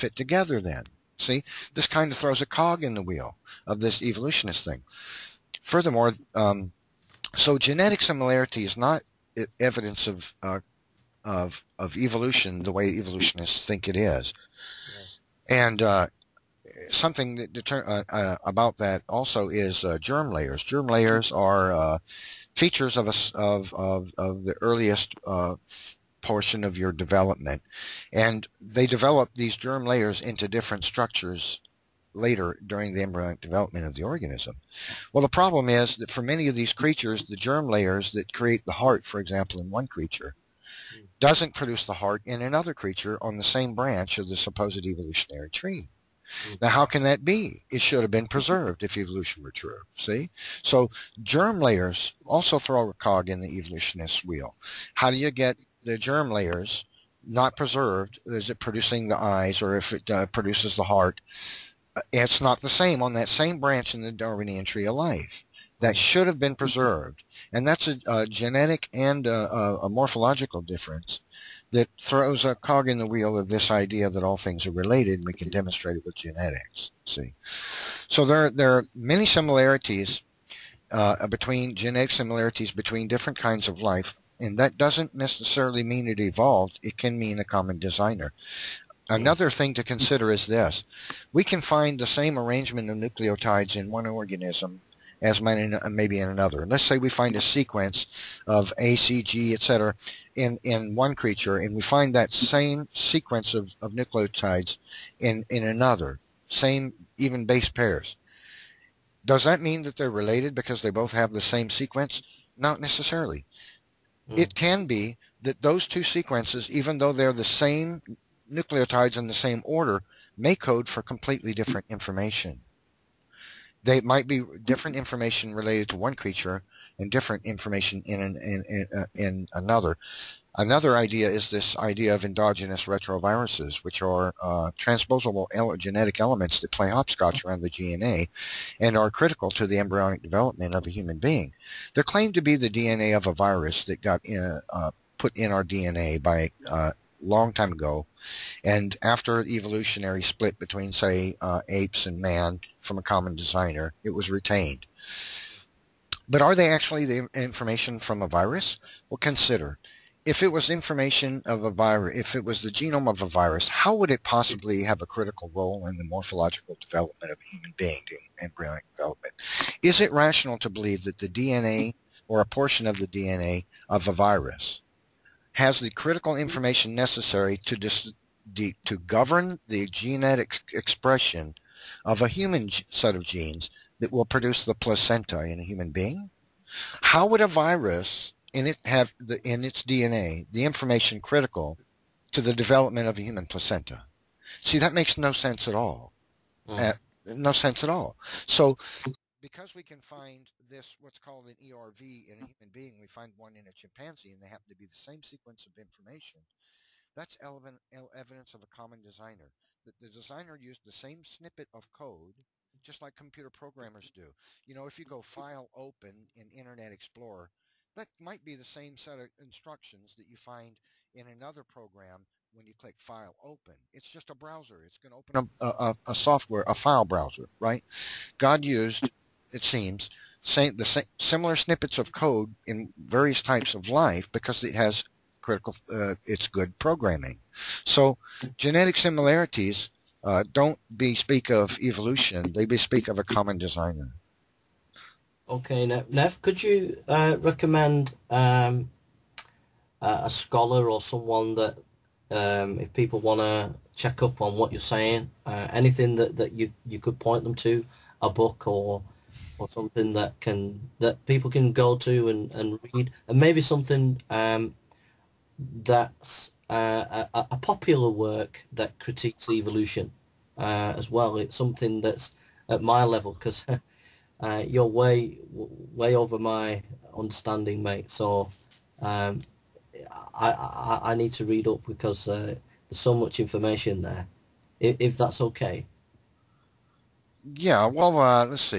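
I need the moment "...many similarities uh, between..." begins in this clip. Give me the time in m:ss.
1:18.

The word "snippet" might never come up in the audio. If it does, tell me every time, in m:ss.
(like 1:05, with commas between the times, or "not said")
3:31, 3:51.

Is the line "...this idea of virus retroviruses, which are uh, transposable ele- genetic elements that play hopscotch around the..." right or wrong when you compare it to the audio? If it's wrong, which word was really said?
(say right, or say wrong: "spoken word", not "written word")
wrong: "endogenous", not "virus".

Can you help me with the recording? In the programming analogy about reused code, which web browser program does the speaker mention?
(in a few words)
Internet Explorer.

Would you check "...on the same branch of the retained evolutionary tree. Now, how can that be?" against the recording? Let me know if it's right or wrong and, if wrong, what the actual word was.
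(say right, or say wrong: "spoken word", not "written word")
wrong: "supposed", not "retained".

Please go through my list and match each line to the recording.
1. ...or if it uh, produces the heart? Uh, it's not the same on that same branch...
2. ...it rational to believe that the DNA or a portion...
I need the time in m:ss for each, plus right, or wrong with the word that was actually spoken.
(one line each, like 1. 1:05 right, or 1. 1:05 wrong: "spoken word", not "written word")
1. 0:59 right
2. 2:49 right.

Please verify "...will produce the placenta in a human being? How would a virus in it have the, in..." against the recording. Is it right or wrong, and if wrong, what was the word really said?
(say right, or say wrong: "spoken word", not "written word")
right.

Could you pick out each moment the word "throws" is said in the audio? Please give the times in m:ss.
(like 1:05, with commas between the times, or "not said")
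0:02, 0:52, 1:12.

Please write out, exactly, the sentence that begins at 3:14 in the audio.
See, that makes no sense at all.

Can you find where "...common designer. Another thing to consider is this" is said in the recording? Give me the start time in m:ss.
1:27.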